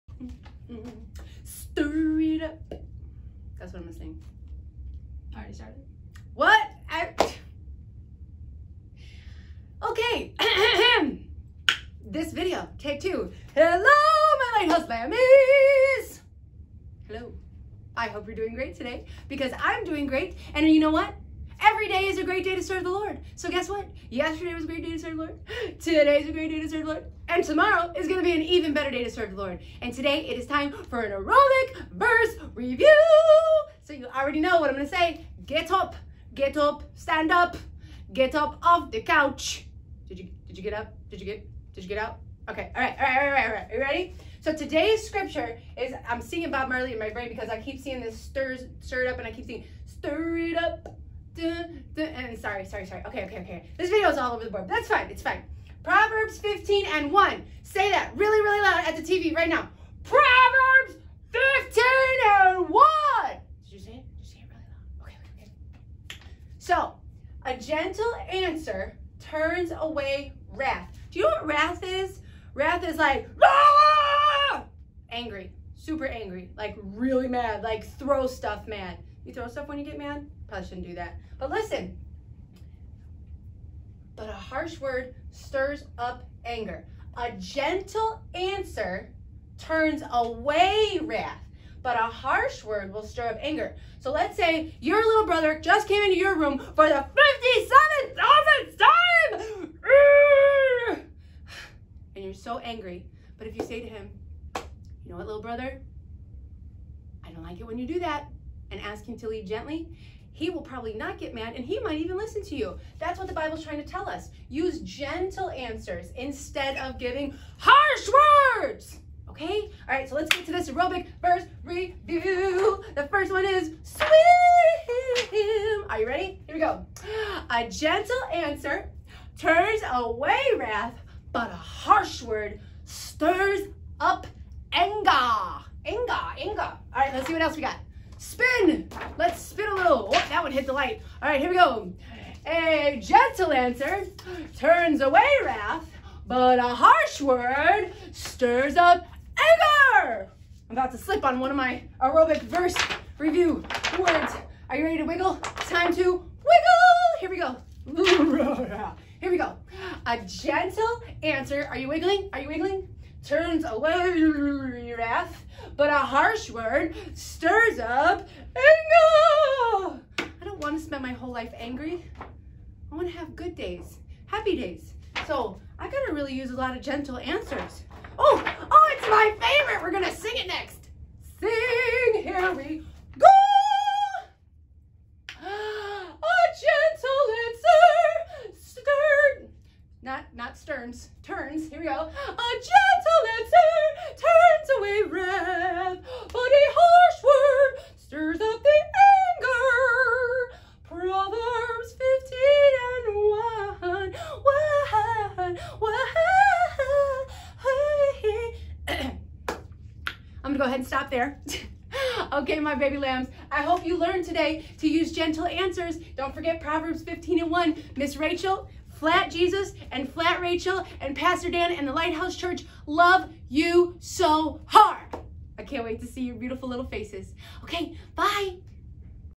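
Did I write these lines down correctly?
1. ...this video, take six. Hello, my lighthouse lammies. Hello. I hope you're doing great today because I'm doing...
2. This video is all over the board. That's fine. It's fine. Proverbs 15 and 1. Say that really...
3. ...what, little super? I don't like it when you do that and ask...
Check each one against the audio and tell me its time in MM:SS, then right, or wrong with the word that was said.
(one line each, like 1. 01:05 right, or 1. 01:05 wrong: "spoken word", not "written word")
1. 00:12 wrong: "two", not "six"
2. 00:53 right
3. 01:45 wrong: "brother", not "super".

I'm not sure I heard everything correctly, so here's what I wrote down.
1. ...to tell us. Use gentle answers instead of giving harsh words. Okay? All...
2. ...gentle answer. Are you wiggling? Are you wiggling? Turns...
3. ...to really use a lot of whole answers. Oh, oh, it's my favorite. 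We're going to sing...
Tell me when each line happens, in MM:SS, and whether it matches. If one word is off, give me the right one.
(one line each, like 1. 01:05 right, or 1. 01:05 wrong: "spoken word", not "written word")
1. 01:53 right
2. 02:40 right
3. 02:56 wrong: "gentle", not "whole".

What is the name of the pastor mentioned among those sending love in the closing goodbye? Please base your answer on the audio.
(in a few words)
Pastor Dan.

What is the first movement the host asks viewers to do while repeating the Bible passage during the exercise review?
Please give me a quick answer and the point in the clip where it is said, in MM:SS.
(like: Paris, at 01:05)
swim, at 02:03.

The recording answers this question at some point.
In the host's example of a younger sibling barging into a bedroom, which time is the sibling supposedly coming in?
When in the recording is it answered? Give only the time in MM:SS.
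01:38.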